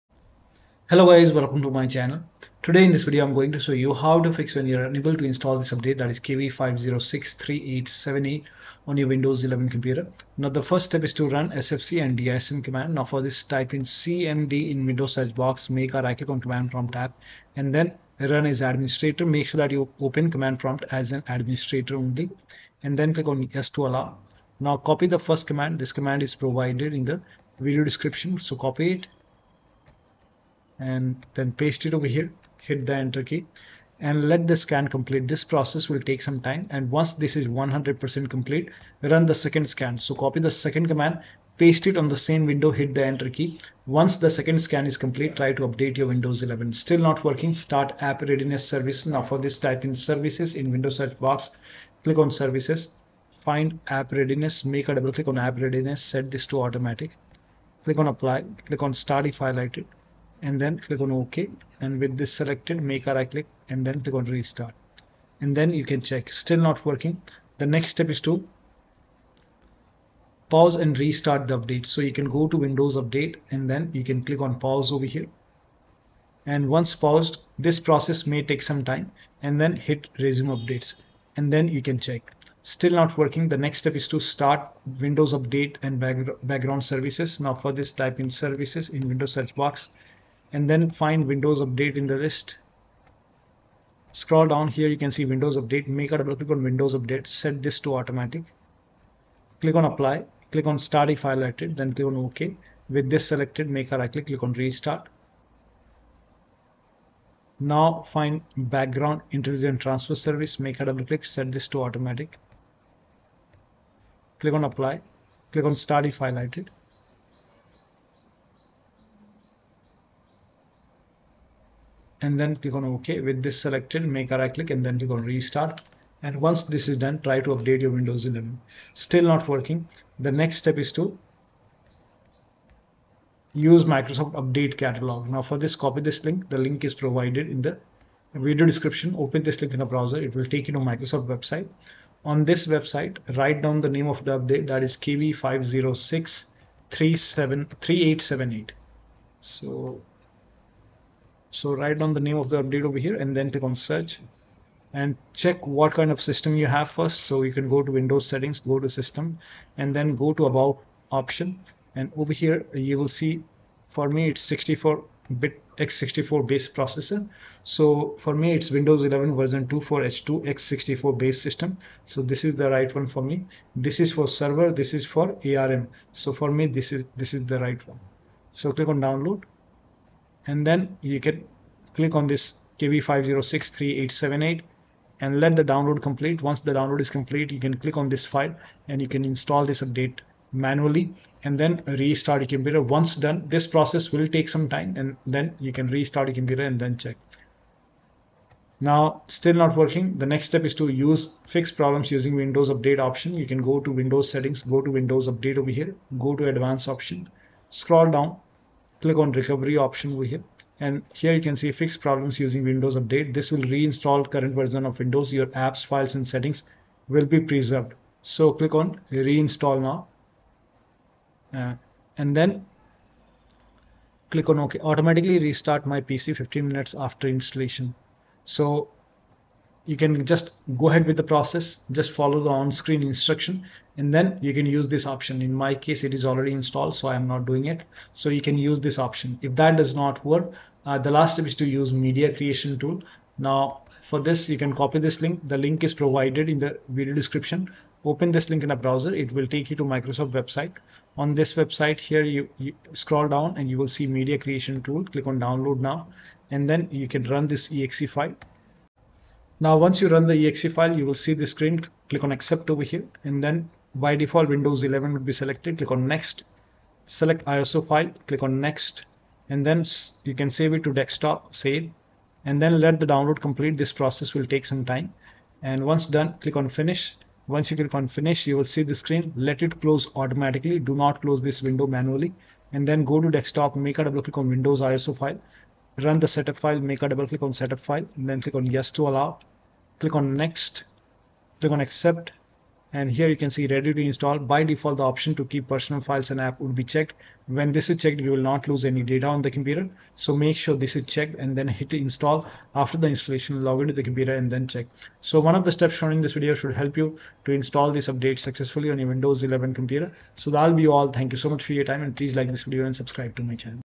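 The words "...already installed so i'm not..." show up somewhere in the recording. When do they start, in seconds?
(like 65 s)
236 s.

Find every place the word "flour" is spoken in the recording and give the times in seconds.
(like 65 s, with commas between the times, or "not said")
not said.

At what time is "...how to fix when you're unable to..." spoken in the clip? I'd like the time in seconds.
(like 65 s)
3 s.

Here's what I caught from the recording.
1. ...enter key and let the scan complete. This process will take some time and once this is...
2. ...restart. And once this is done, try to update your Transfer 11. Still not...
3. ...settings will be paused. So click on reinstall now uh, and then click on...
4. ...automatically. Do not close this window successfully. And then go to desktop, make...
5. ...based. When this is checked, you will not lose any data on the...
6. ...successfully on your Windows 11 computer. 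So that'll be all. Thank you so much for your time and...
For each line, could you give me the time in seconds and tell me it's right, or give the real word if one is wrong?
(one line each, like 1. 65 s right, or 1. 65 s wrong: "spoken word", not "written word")
1. 32 s right
2. 125 s wrong: "Windows", not "Transfer"
3. 216 s wrong: "preserved", not "paused"
4. 280 s wrong: "manually", not "successfully"
5. 296 s wrong: "checked", not "based"
6. 308 s right.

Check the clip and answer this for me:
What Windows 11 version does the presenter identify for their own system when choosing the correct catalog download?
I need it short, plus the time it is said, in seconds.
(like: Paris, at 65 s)
24H2, at 169 s.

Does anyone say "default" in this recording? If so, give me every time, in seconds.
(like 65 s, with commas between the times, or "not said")
264 s, 294 s.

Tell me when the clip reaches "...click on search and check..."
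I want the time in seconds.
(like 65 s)
153 s.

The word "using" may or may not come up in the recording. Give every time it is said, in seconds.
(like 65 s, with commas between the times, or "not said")
202 s, 212 s.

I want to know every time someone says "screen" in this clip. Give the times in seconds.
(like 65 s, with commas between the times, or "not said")
232 s, 261 s, 278 s.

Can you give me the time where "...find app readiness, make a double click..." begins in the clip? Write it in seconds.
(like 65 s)
53 s.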